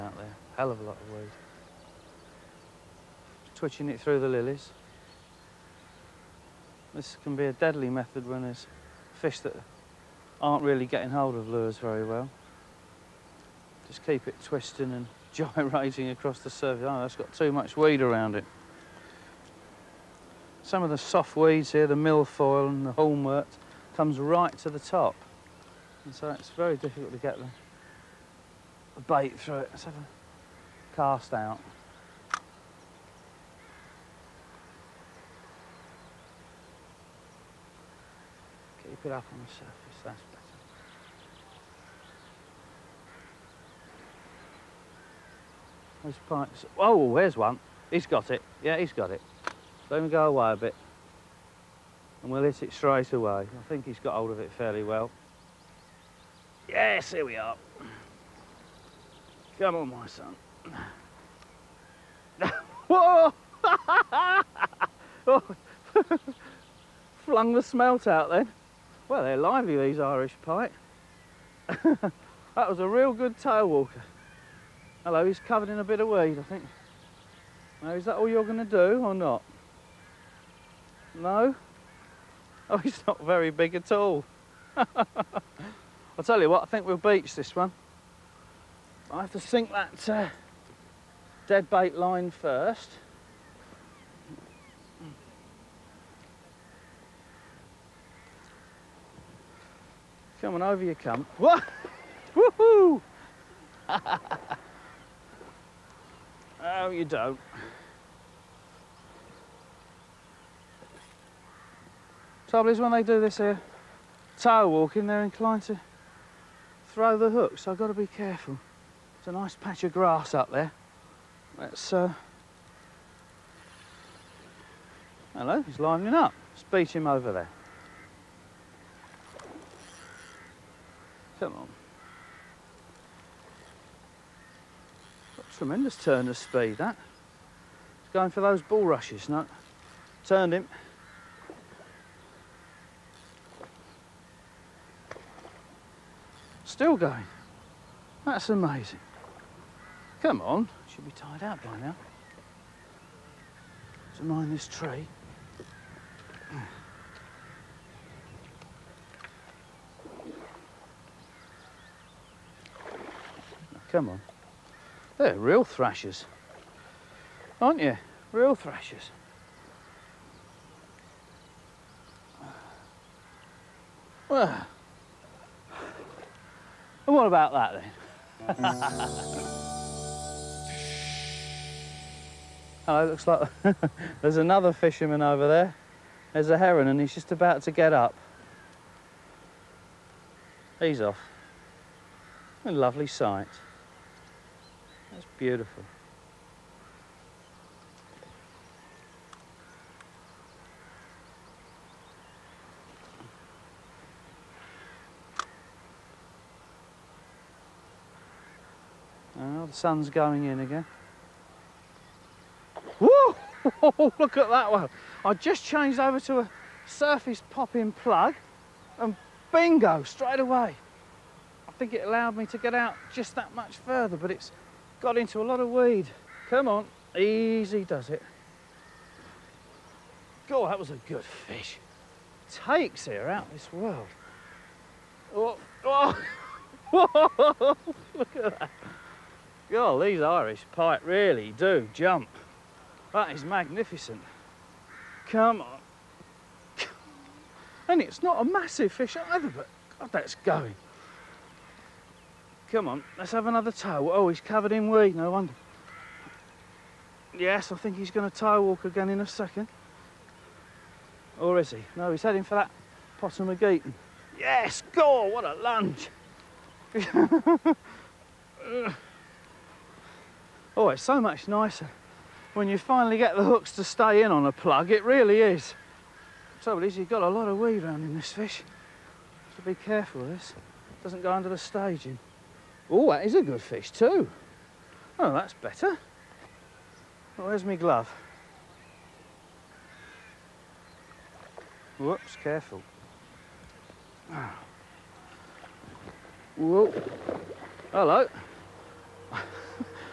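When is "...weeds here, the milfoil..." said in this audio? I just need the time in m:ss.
0:21.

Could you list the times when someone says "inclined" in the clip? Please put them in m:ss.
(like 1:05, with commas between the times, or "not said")
1:55.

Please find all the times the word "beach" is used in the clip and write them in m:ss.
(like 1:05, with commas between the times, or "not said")
1:26.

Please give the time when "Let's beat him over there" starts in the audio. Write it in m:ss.
2:06.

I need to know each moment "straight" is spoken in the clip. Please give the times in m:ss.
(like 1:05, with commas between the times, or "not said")
0:52, 3:40.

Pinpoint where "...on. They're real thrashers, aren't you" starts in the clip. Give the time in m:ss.
2:44.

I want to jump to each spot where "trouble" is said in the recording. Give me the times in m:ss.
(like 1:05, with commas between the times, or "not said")
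1:52, 4:36.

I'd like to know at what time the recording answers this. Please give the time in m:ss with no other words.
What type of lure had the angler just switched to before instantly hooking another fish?
3:36.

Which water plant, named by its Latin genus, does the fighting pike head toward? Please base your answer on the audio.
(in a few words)
Potamogeton.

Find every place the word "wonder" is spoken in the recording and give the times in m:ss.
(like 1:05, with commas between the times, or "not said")
4:15.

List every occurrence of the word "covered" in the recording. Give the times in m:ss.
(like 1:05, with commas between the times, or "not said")
1:15, 4:14.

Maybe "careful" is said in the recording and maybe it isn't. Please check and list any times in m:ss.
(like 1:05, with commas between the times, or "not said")
1:58, 4:39, 4:52.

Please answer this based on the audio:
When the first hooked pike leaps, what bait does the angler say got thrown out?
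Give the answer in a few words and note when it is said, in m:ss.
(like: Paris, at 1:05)
smelt, at 1:07.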